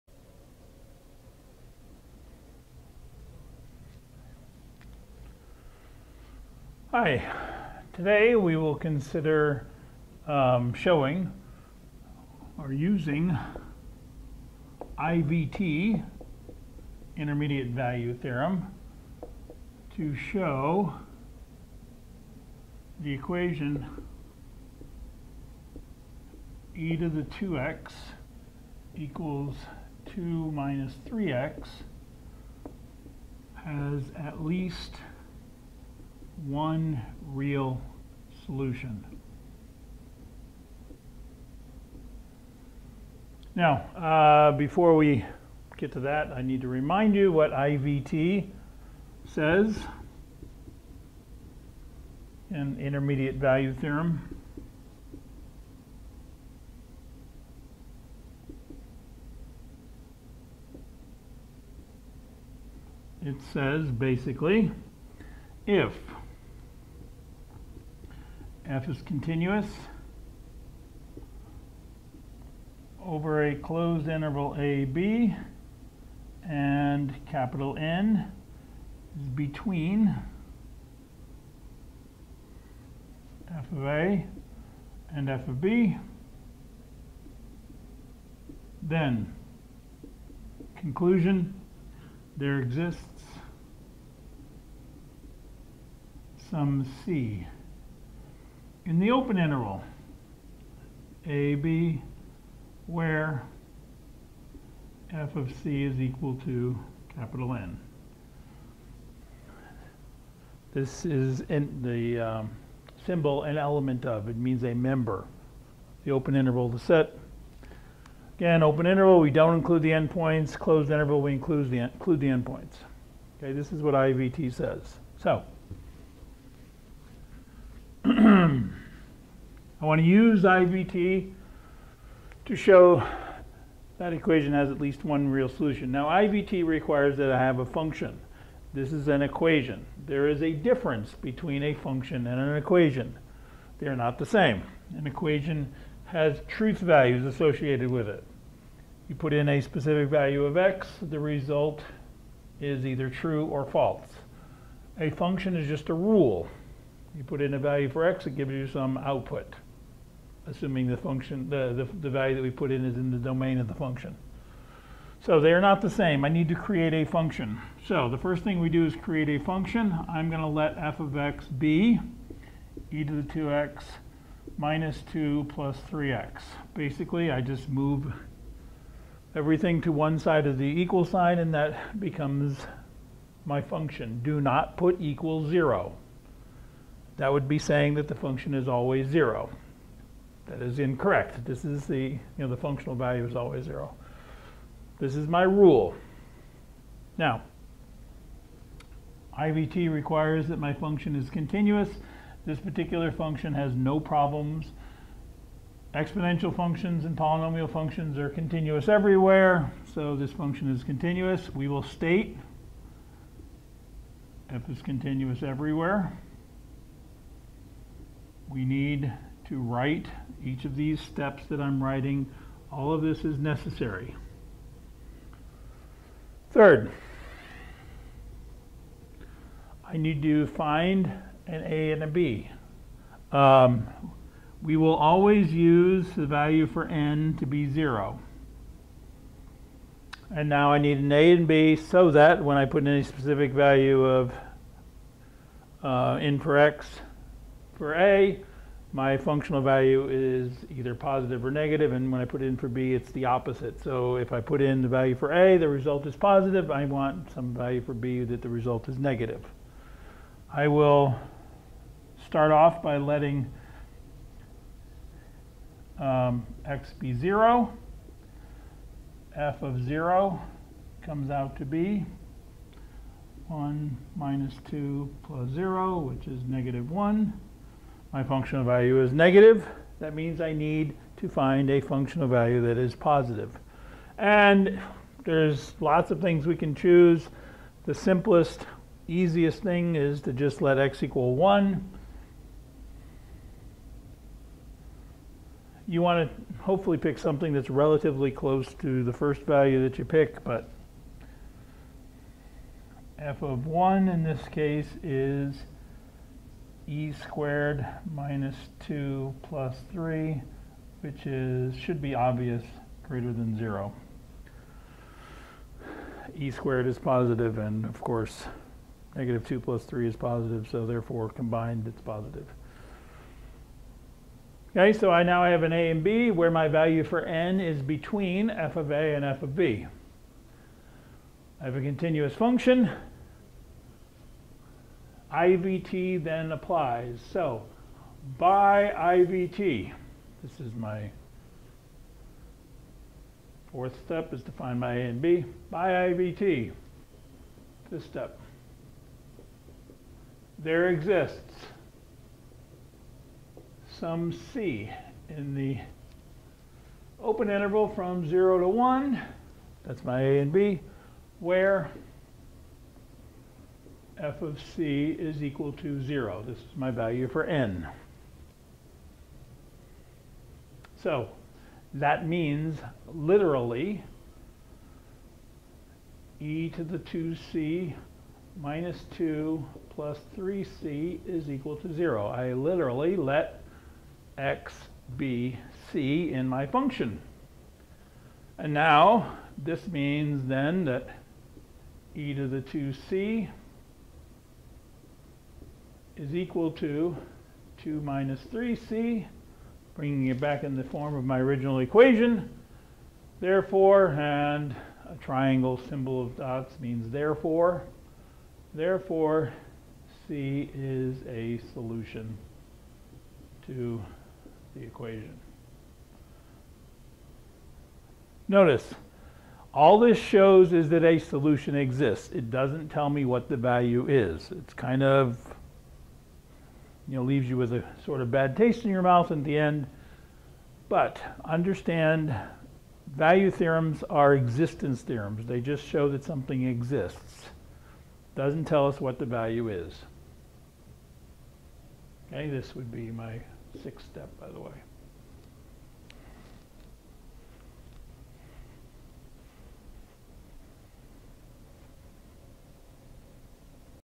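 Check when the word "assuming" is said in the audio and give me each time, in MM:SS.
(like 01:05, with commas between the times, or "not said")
02:40.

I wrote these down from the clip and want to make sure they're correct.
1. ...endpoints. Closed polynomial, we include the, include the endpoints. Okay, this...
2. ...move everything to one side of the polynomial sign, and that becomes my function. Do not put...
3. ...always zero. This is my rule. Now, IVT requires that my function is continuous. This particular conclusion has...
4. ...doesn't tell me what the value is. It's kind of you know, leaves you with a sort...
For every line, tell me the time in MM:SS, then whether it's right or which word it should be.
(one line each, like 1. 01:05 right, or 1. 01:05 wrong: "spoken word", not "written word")
1. 01:59 wrong: "interval", not "polynomial"
2. 02:57 wrong: "equal", not "polynomial"
3. 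03:13 wrong: "function", not "conclusion"
4. 07:02 right.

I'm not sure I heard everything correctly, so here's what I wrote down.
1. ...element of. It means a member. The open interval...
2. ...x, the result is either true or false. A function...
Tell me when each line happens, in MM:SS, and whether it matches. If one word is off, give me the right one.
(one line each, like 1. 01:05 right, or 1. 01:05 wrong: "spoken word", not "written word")
1. 01:53 right
2. 02:30 right.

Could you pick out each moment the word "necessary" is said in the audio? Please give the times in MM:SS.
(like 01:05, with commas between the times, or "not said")
03:43.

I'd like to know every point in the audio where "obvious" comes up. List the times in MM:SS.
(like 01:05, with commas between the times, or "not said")
05:12.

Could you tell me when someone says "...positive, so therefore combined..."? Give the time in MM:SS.
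05:20.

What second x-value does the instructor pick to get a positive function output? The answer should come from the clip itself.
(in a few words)
1.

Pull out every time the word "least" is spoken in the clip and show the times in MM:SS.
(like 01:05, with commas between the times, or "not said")
00:34, 02:14.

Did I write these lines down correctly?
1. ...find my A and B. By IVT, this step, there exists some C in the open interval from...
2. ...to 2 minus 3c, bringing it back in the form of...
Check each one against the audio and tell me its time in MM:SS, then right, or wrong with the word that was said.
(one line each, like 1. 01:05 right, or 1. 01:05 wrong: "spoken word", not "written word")
1. 05:44 right
2. 06:36 right.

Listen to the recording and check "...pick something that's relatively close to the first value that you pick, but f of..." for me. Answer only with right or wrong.
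right.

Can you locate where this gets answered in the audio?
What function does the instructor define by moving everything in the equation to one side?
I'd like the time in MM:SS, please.
02:52.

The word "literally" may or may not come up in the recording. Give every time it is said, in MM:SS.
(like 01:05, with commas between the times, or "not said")
06:13, 06:22.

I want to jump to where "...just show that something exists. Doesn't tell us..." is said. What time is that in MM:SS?
07:15.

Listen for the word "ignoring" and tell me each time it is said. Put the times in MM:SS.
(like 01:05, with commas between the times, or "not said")
not said.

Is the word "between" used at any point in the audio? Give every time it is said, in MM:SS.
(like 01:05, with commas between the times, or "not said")
01:19, 02:21, 05:27.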